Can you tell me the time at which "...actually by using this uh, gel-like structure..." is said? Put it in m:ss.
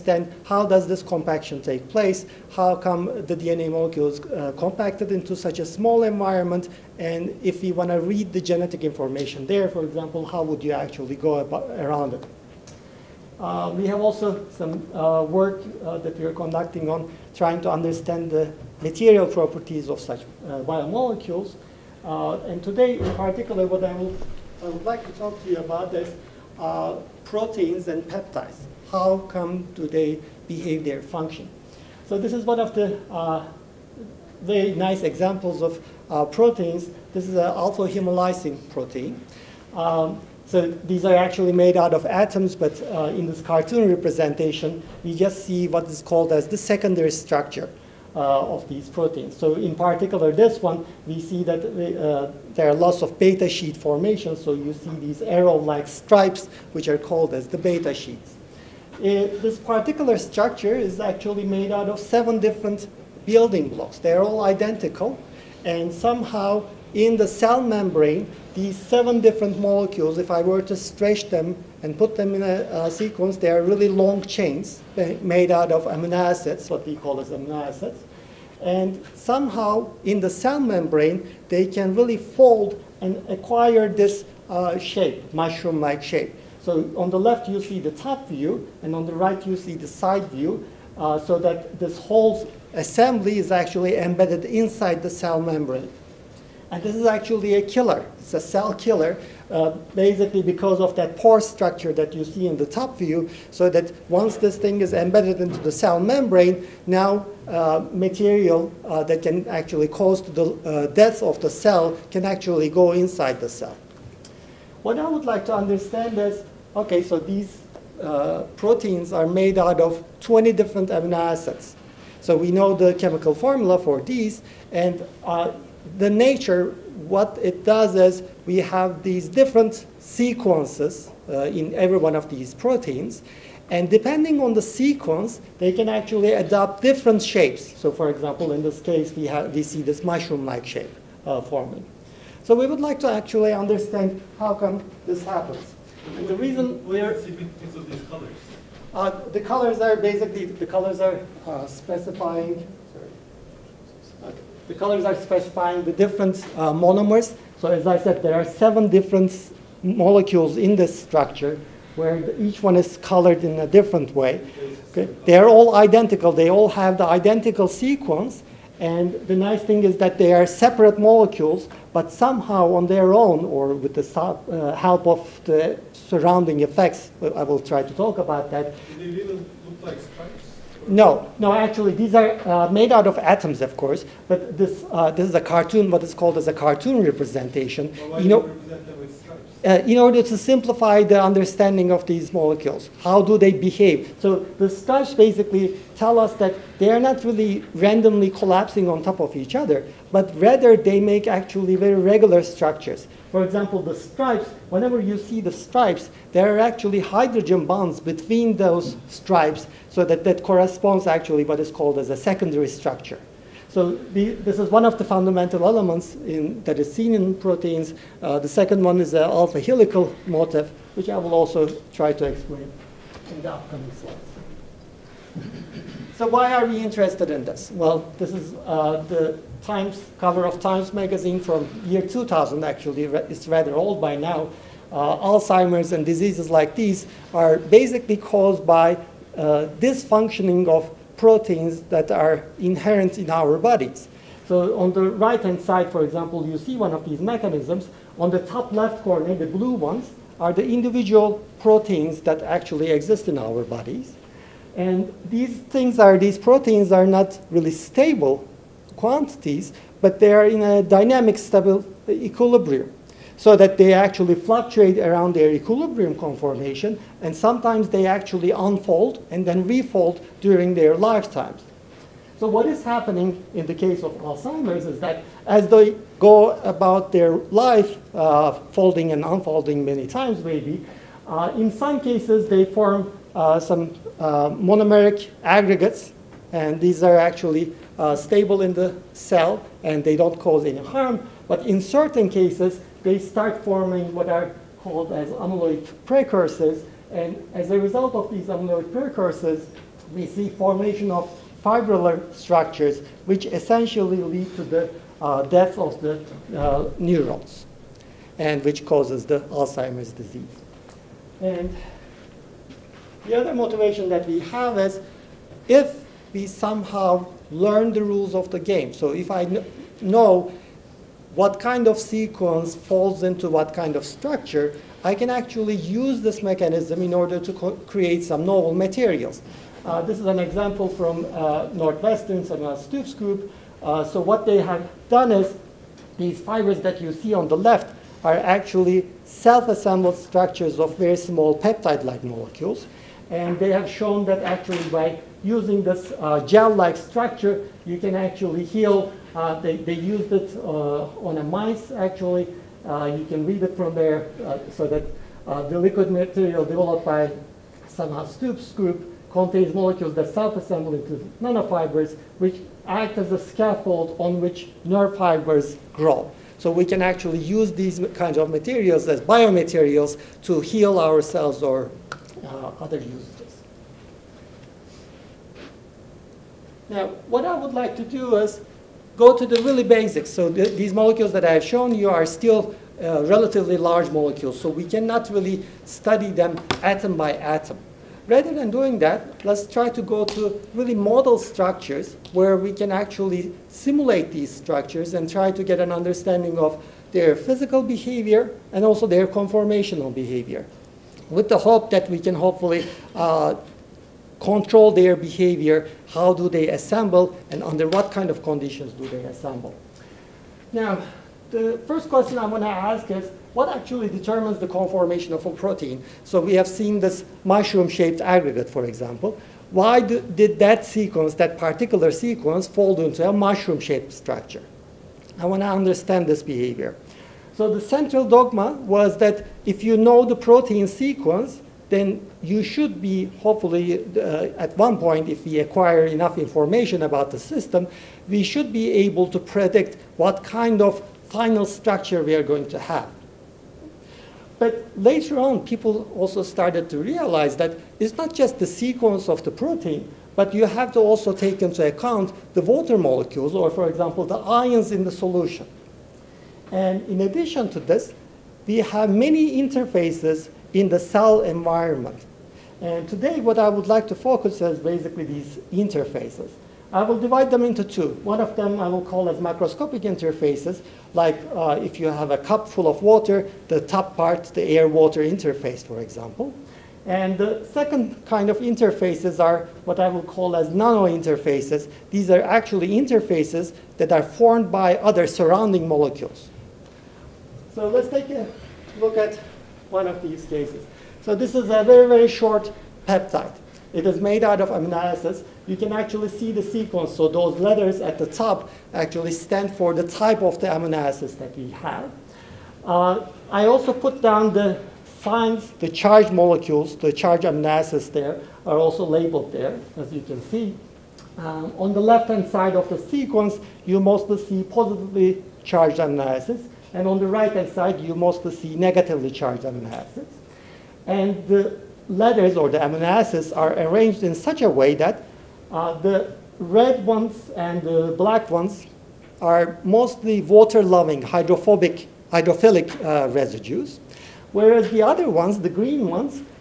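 5:44.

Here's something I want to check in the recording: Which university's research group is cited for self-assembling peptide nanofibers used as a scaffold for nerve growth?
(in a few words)
Northwestern.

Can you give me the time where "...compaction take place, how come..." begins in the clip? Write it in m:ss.
0:01.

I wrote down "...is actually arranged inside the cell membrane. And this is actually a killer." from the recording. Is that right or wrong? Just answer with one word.
wrong.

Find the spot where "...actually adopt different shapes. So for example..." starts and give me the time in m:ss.
2:15.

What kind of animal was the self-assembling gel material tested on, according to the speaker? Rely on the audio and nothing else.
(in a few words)
mice.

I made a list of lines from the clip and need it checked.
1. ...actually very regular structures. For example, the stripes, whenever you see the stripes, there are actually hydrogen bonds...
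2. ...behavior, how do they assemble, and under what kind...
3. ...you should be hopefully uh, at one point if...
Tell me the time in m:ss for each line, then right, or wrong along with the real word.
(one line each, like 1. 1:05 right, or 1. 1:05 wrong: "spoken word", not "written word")
1. 3:21 right
2. 6:45 right
3. 7:12 right.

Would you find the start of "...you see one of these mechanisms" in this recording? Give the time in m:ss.
4:06.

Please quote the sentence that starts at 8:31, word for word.
Um, on the left-hand side of the sequence, you mostly see positively charged amino acids.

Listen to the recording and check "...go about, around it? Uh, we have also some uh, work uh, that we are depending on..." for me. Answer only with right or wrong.
wrong.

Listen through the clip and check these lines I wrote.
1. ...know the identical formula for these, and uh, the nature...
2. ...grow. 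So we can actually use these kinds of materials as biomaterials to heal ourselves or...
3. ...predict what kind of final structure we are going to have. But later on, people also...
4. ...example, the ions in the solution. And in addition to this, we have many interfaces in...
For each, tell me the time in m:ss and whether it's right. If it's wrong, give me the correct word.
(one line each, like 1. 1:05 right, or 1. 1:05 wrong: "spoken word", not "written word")
1. 2:02 wrong: "chemical", not "identical"
2. 6:05 right
3. 7:19 right
4. 7:33 right.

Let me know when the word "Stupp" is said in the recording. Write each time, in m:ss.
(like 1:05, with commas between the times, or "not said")
5:32, 5:58.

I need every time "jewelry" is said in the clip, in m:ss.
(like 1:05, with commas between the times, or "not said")
not said.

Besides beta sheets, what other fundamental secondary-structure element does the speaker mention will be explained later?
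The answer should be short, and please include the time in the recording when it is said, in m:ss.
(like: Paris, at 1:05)
alpha helical motif, at 3:39.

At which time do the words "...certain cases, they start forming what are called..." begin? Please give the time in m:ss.
4:51.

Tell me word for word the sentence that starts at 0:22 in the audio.
Uh, and today, in particular, what I, will, I would like to talk to you about is uh, proteins and peptides.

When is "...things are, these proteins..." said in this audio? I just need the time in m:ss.
4:15.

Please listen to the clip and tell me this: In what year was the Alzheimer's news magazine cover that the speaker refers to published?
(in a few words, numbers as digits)
2000.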